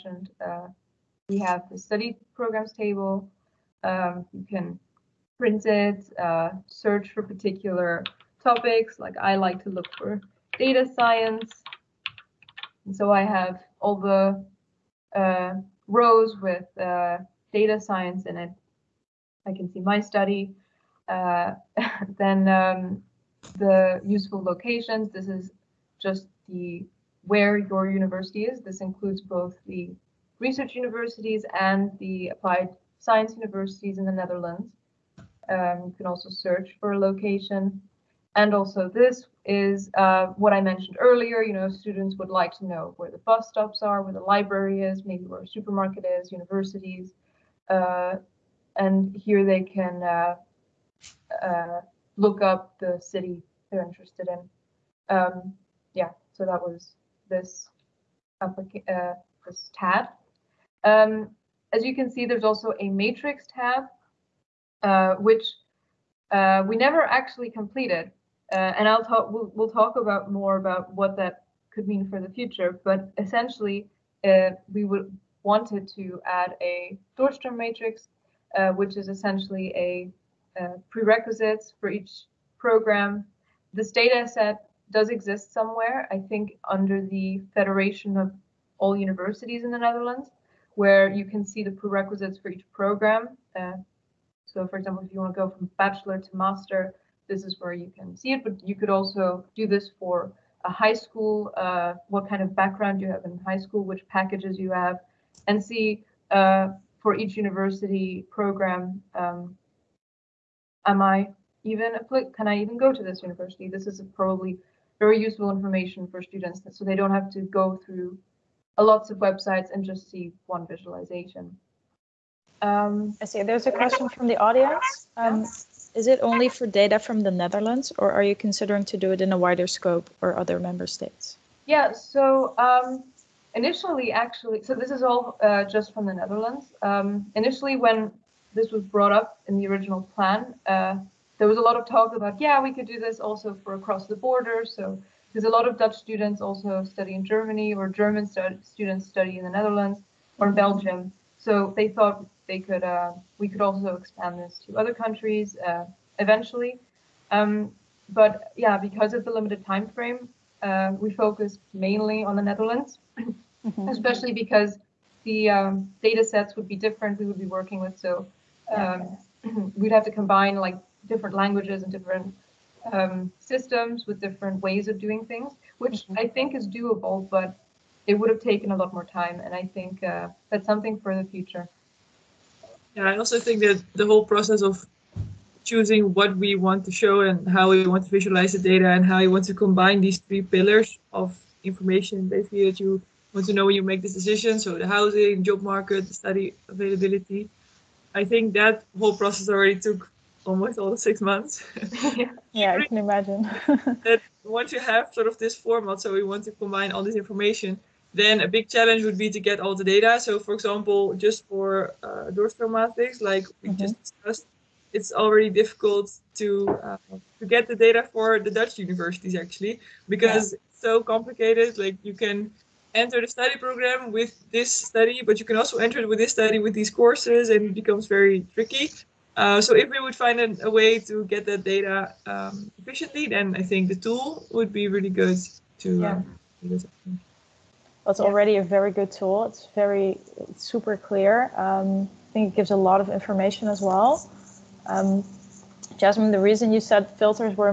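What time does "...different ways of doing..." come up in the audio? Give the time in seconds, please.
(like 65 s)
174 s.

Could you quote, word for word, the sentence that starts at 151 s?
So they thought they could uh, we could also expand this to other countries uh, eventually.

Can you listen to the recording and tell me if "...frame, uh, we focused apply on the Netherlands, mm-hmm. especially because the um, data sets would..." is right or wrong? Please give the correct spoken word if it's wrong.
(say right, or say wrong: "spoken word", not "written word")
wrong: "mainly", not "apply".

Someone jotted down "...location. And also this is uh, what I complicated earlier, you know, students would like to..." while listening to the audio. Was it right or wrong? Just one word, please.
wrong.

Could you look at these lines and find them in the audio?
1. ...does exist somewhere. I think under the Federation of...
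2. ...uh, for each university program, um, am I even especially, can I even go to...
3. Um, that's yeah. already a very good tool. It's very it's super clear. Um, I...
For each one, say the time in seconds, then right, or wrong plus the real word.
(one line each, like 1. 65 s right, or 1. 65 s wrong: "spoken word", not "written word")
1. 84 s right
2. 106 s wrong: "apply", not "especially"
3. 236 s right.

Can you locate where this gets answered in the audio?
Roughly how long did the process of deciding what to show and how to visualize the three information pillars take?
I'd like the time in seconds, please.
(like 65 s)
200 s.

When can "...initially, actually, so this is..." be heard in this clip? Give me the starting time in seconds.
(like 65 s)
133 s.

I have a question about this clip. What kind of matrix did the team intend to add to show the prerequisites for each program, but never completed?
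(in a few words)
doorstroom matrix.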